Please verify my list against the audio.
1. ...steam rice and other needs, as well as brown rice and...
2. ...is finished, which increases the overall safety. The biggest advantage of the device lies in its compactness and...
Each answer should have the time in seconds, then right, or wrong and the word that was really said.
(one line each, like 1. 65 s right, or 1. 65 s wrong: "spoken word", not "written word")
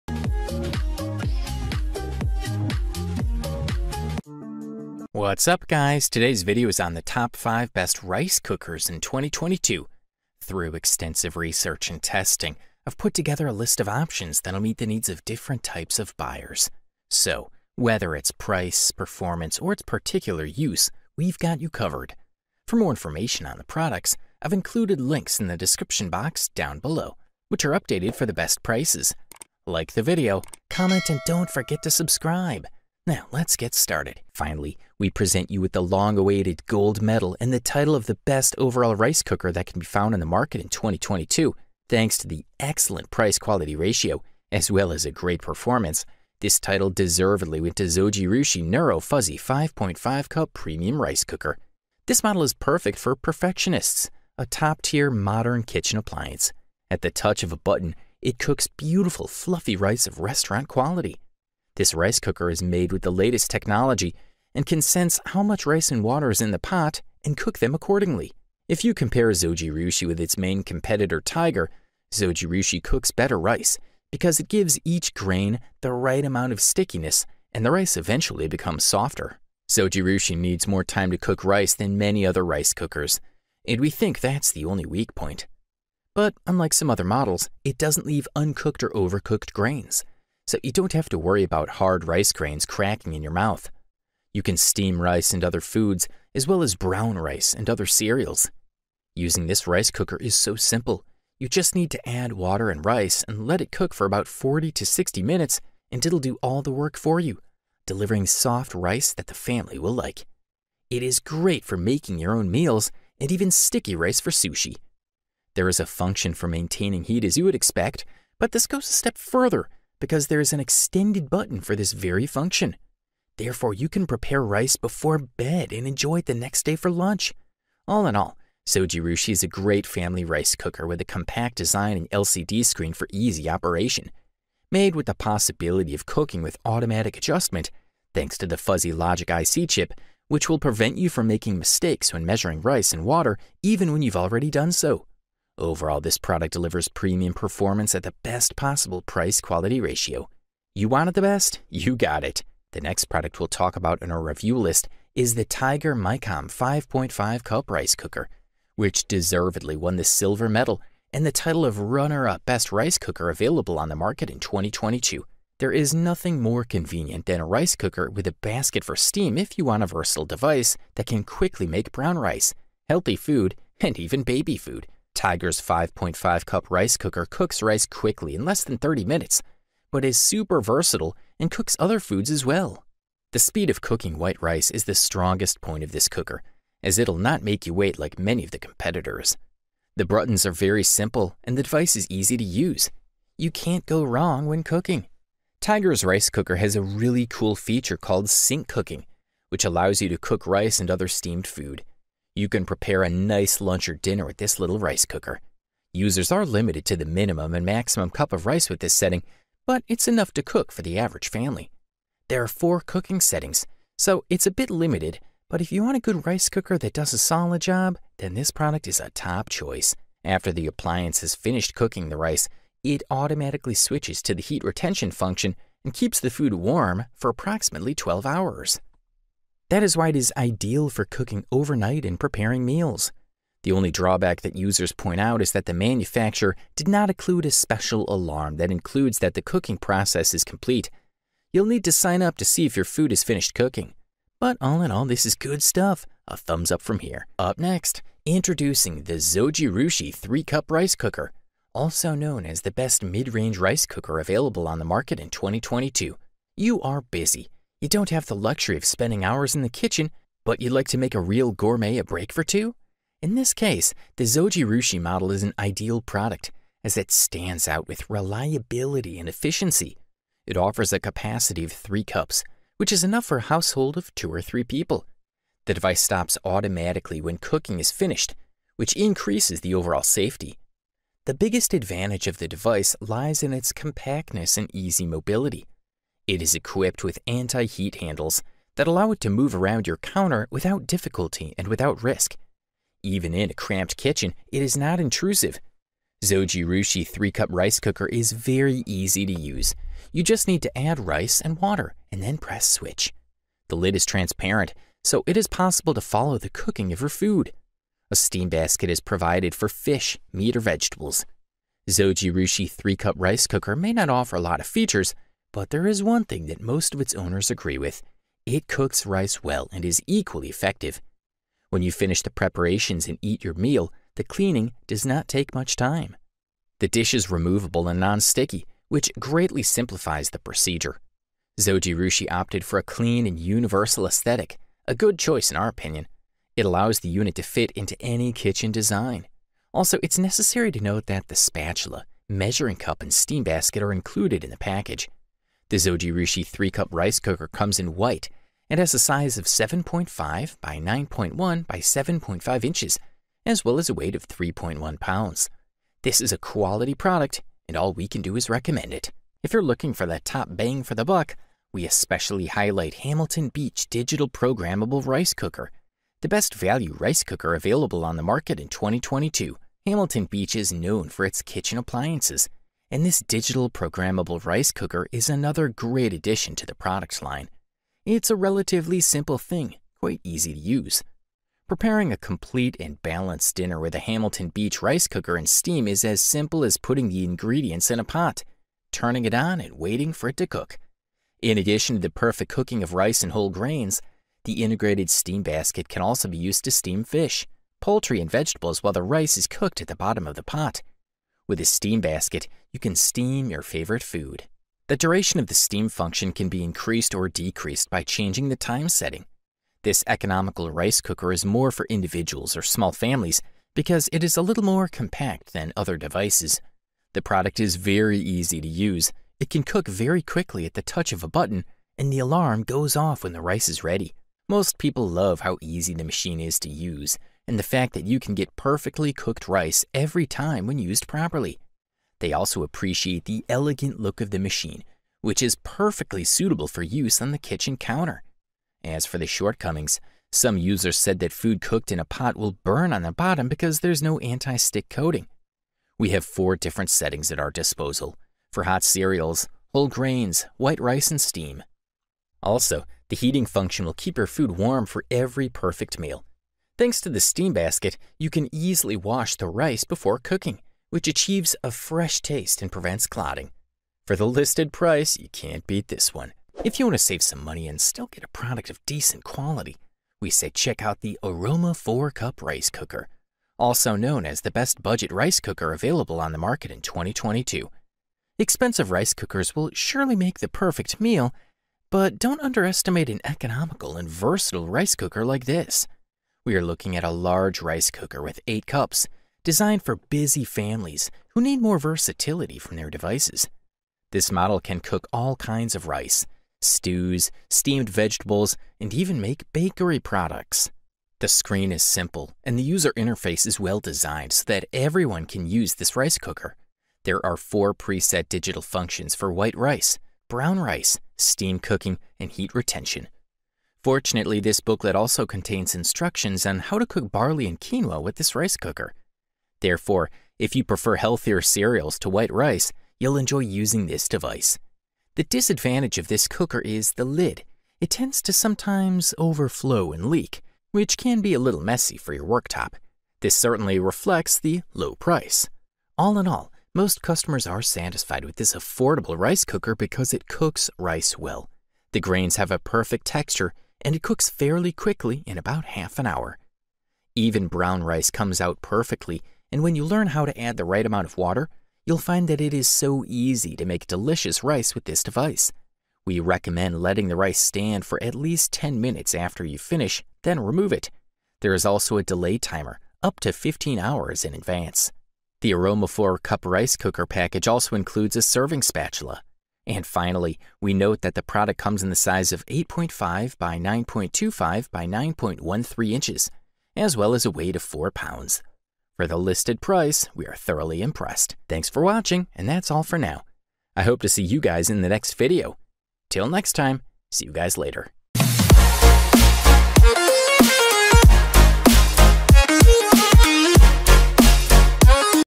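1. 94 s wrong: "foods", not "needs"
2. 277 s right.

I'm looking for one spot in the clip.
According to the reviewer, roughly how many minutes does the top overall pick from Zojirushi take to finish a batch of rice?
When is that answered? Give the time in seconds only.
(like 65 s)
104 s.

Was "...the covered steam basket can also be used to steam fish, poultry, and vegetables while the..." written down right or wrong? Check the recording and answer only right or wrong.
wrong.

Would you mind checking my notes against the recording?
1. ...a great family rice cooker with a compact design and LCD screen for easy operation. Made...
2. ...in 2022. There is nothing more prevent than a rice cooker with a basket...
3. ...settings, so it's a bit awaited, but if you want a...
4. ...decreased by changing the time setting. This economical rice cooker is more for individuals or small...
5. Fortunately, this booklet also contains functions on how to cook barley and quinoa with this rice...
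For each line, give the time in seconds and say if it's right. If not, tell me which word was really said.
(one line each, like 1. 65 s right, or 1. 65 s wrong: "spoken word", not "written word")
1. 129 s right
2. 164 s wrong: "convenient", not "prevent"
3. 213 s wrong: "limited", not "awaited"
4. 407 s right
5. 513 s wrong: "instructions", not "functions".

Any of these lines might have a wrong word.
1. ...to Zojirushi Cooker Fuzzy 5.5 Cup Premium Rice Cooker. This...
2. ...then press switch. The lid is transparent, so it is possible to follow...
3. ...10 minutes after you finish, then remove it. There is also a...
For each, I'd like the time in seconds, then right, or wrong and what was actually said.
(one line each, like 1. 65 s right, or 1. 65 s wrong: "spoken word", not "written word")
1. 47 s wrong: "Neuro", not "Cooker"
2. 302 s right
3. 558 s right.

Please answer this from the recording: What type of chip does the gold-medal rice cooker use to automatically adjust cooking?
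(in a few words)
fuzzy logic IC chip.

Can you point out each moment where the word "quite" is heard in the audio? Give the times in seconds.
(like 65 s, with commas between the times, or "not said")
380 s.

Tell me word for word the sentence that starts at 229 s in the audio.
That is why it is ideal for cooking overnight and preparing meals.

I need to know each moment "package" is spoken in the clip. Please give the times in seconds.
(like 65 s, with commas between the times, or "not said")
344 s, 567 s.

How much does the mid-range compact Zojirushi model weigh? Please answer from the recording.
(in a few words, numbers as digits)
3.1 pounds.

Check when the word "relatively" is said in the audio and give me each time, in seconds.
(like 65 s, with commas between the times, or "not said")
378 s.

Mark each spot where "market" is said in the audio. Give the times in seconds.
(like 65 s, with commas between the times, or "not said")
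40 s, 163 s, 254 s, 368 s, 476 s.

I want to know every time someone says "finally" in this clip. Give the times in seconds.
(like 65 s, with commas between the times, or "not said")
34 s, 569 s.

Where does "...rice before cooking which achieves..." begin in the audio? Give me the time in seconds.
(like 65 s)
459 s.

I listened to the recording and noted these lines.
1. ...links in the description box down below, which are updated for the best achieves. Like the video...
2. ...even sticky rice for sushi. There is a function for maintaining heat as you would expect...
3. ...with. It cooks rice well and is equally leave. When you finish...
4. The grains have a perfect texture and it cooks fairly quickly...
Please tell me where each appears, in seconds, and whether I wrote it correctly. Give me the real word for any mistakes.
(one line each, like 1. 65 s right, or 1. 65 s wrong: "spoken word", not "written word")
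1. 25 s wrong: "prices", not "achieves"
2. 113 s right
3. 317 s wrong: "effective", not "leave"
4. 541 s right.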